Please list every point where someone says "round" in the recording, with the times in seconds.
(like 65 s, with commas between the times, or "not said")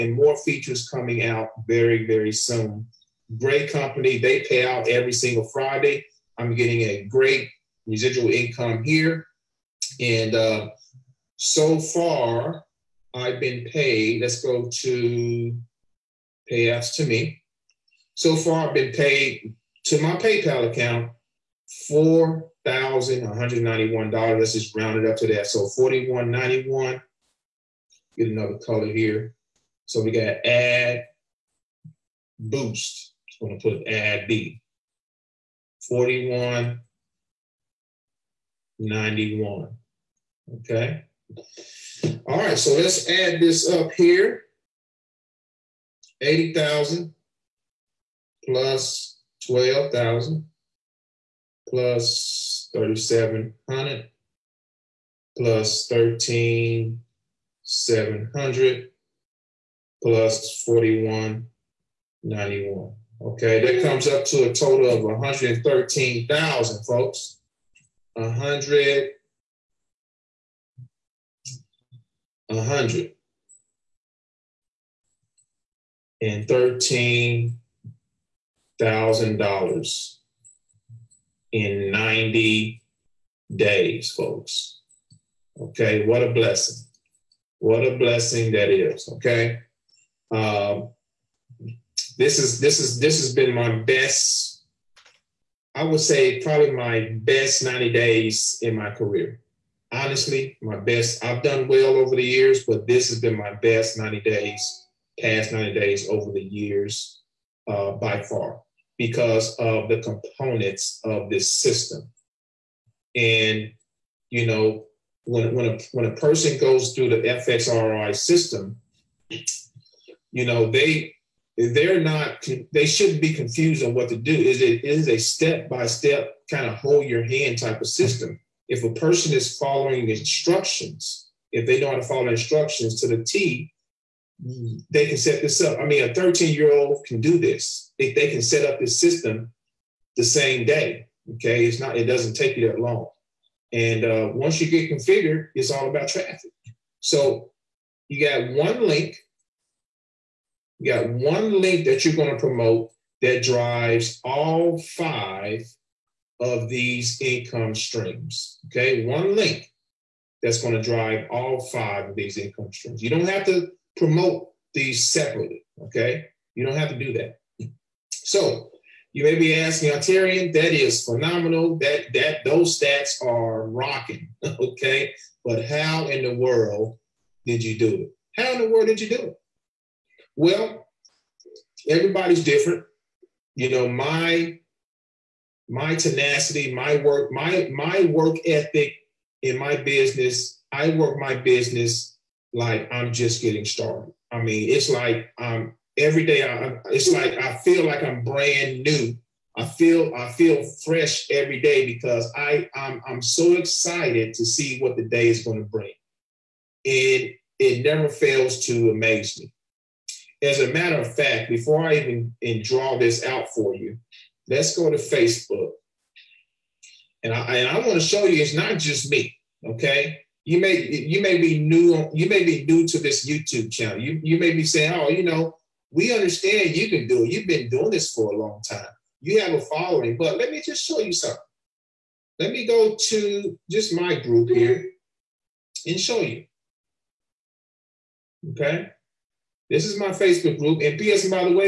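24 s.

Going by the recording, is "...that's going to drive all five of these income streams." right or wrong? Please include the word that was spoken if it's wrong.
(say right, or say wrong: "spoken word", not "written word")
right.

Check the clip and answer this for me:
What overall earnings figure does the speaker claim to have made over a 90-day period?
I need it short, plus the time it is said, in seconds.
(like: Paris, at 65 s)
$113,000, at 65 s.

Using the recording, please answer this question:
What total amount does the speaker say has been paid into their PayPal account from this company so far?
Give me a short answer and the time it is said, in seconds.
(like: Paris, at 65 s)
$4,191, at 21 s.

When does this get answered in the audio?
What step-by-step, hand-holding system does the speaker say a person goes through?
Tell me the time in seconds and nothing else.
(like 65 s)
117 s.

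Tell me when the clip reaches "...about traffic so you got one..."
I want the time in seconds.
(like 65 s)
145 s.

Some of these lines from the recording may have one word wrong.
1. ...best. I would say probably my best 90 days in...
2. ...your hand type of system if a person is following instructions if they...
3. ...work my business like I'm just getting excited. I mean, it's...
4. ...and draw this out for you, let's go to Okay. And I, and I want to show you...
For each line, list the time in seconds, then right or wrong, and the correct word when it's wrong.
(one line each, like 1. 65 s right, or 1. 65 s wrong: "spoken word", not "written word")
1. 93 s right
2. 127 s right
3. 190 s wrong: "started", not "excited"
4. 212 s wrong: "Facebook", not "Okay".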